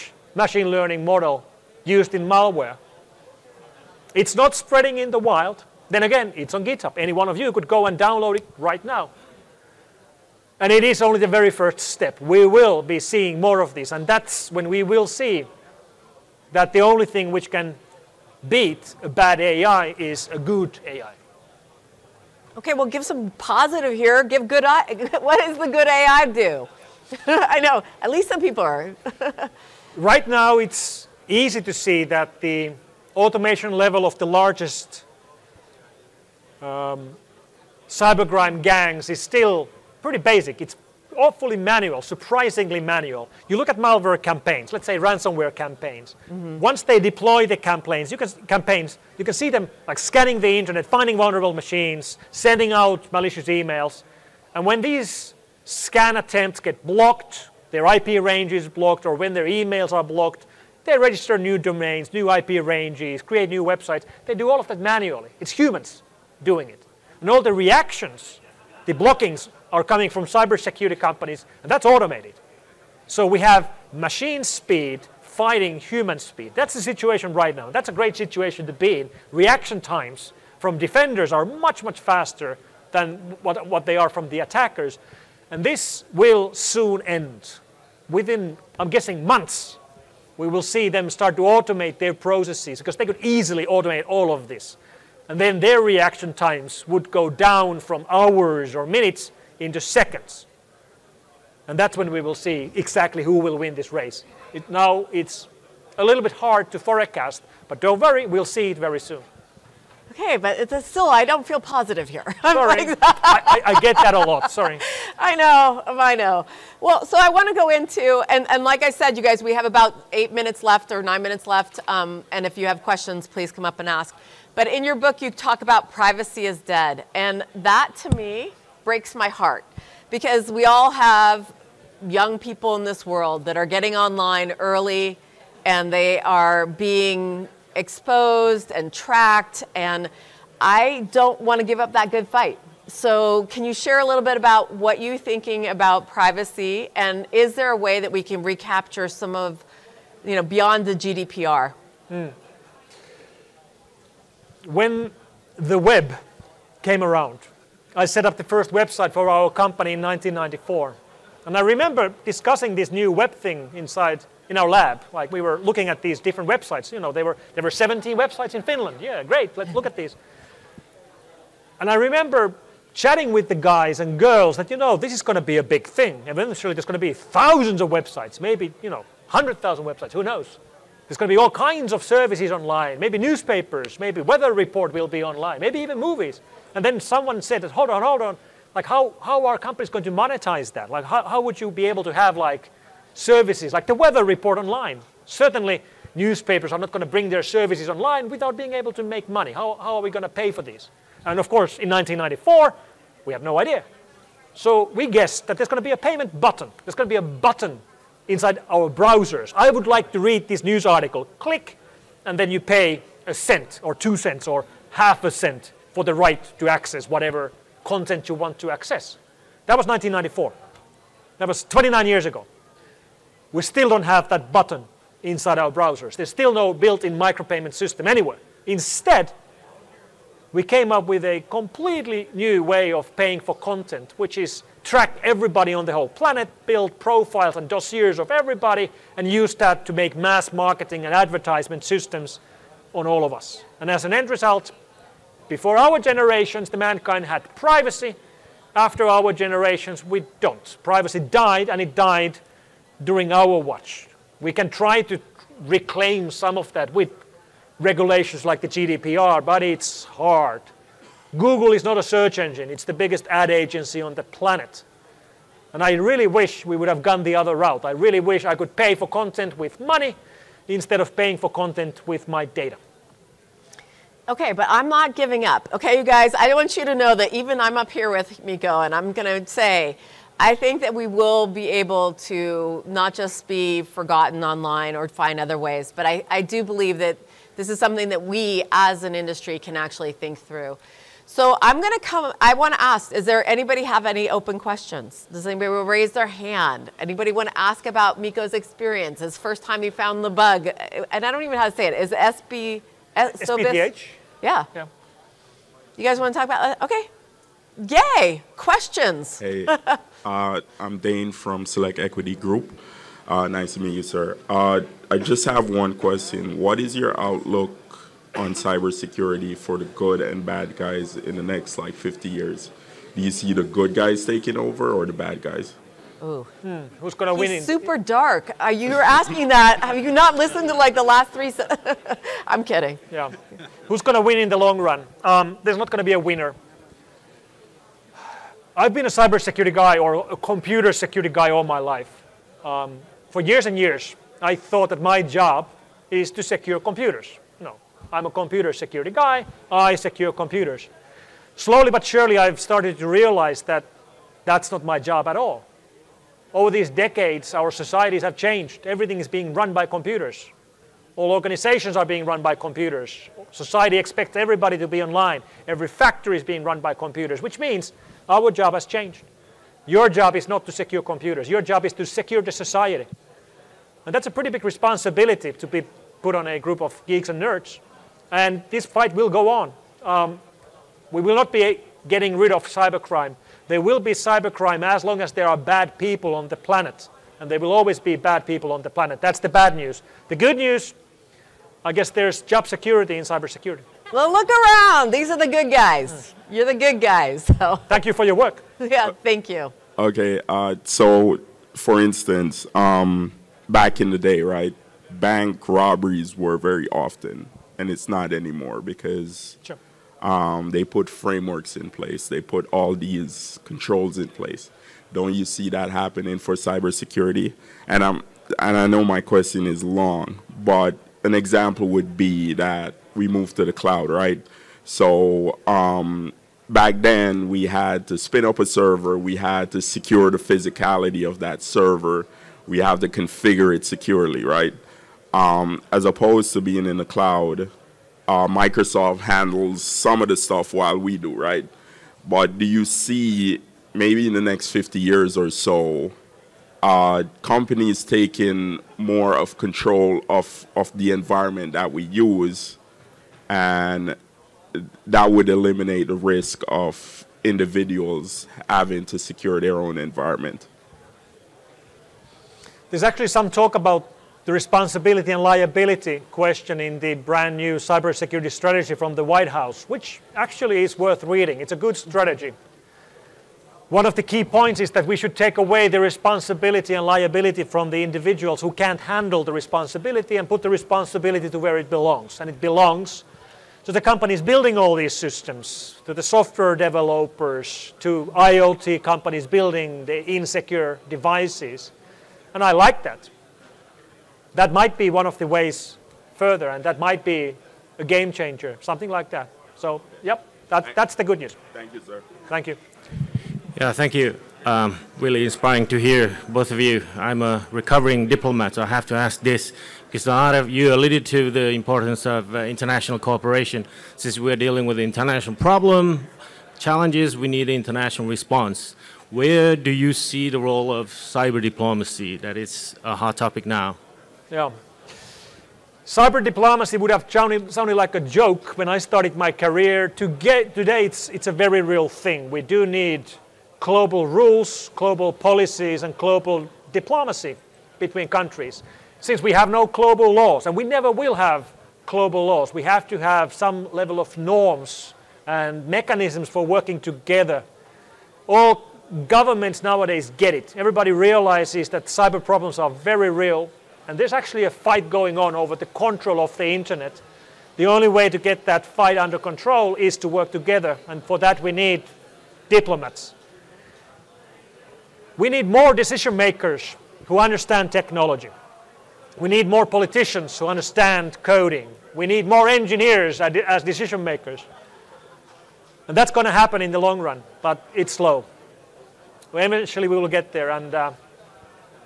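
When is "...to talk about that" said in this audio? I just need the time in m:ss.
5:06.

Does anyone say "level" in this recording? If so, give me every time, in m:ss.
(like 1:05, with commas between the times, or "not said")
0:33, 9:03.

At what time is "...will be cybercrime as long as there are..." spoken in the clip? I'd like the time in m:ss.
6:23.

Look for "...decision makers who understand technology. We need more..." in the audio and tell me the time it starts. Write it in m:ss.
9:25.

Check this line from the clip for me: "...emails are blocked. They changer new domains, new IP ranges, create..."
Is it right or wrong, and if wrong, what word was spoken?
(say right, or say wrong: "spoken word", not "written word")
wrong: "register", not "changer".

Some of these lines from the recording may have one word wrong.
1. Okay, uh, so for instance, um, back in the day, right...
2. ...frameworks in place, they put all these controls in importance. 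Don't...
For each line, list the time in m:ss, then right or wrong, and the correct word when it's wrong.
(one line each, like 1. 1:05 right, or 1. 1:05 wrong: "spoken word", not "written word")
1. 6:39 right
2. 6:51 wrong: "place", not "importance".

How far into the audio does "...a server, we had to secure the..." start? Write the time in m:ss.
7:08.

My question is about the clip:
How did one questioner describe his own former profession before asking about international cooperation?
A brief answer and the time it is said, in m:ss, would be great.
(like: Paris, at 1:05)
recovering diplomat, at 8:27.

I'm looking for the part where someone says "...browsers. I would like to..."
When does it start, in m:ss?
3:28.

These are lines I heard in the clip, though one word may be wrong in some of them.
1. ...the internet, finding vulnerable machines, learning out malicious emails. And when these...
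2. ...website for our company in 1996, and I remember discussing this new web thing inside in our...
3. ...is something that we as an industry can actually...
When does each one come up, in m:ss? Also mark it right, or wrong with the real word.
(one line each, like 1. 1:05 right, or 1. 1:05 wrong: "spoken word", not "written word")
1. 0:50 wrong: "sending", not "learning"
2. 2:38 wrong: "1994", not "1996"
3. 4:47 right.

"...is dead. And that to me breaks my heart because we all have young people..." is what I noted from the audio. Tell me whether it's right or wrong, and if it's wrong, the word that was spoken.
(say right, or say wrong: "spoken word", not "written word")
right.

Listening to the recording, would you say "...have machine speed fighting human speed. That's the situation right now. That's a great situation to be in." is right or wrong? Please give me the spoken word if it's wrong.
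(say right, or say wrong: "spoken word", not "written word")
right.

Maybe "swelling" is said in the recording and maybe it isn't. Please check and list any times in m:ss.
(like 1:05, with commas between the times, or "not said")
not said.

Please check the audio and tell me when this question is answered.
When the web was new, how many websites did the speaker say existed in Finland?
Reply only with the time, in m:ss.
2:47.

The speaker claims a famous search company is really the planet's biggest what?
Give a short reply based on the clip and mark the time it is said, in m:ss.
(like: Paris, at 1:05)
ad agency, at 4:23.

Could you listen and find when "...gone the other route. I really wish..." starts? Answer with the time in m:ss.
4:27.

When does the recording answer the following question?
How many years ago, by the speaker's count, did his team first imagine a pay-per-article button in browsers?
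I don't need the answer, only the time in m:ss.
3:41.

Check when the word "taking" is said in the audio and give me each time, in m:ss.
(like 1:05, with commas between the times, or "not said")
5:24, 7:28.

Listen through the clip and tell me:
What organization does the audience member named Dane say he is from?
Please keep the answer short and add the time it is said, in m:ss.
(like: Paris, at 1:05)
Select Equity Group, at 5:11.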